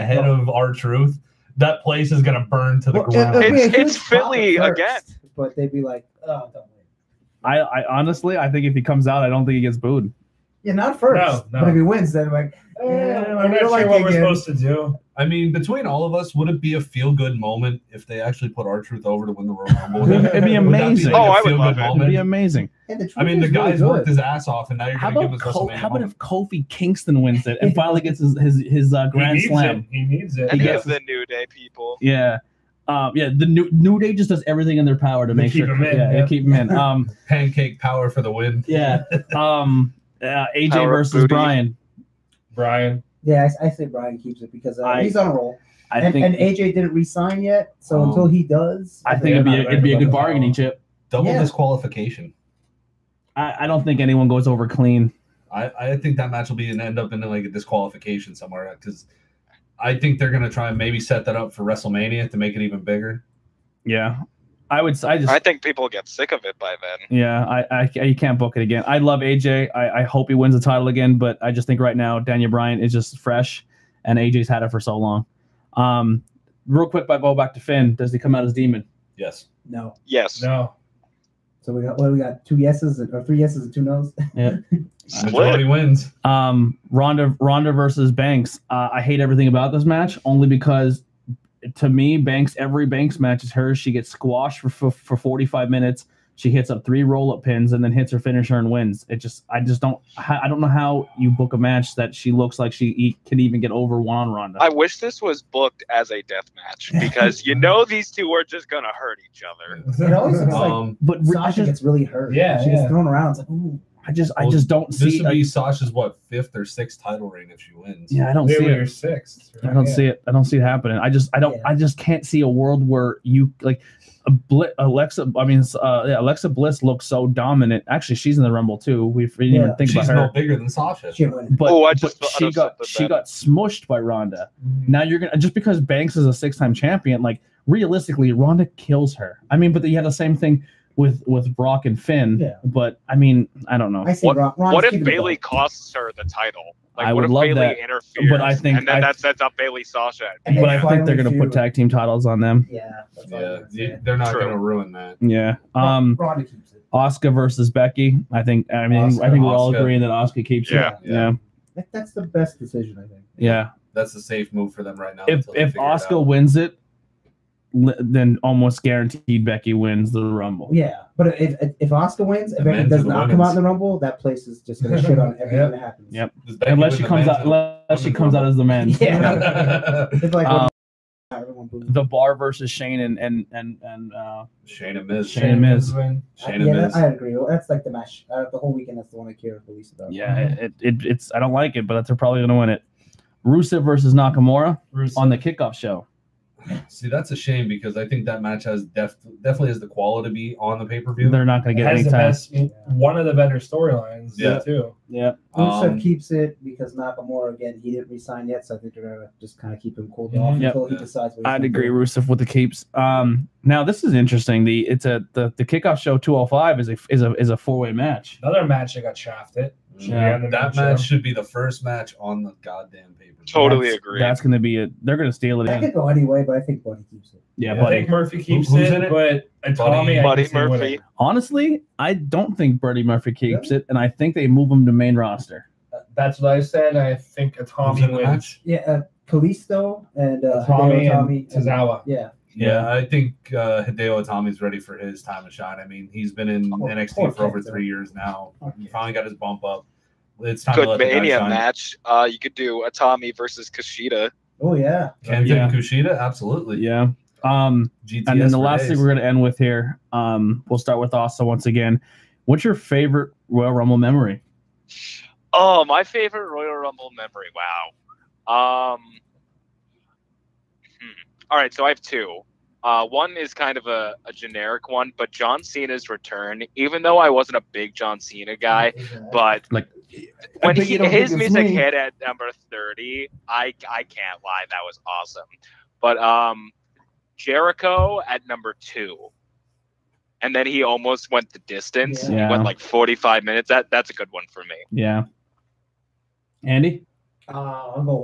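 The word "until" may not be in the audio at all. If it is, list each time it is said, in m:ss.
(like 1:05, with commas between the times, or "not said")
0:48, 3:30.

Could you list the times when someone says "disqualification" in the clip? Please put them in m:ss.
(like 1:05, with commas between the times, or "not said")
0:51, 0:57.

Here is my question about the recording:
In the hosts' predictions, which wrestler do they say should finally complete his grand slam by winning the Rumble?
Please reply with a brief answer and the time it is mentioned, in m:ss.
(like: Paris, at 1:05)
Kofi Kingston, at 0:26.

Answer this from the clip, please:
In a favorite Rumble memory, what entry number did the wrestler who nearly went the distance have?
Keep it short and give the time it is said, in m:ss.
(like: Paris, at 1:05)
2, at 4:48.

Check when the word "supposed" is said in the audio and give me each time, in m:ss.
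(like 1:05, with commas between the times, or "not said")
0:14.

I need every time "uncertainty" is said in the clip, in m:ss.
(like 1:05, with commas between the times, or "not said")
not said.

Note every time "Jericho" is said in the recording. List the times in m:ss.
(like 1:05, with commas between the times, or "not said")
4:47.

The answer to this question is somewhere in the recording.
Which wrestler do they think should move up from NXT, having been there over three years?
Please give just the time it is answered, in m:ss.
4:03.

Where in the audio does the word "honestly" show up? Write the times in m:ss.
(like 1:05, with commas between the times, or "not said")
0:07, 3:51.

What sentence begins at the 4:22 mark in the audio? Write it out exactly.
What's your favorite Royal Rumble memory?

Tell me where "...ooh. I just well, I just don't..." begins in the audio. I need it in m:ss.
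1:53.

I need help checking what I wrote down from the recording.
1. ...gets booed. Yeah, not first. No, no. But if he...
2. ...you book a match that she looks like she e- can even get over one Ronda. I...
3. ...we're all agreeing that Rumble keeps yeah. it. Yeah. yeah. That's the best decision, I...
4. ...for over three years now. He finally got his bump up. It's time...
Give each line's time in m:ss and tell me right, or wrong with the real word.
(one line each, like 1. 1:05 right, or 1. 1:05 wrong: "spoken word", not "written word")
1. 0:09 right
2. 1:41 right
3. 2:39 wrong: "Asuka", not "Rumble"
4. 4:07 right.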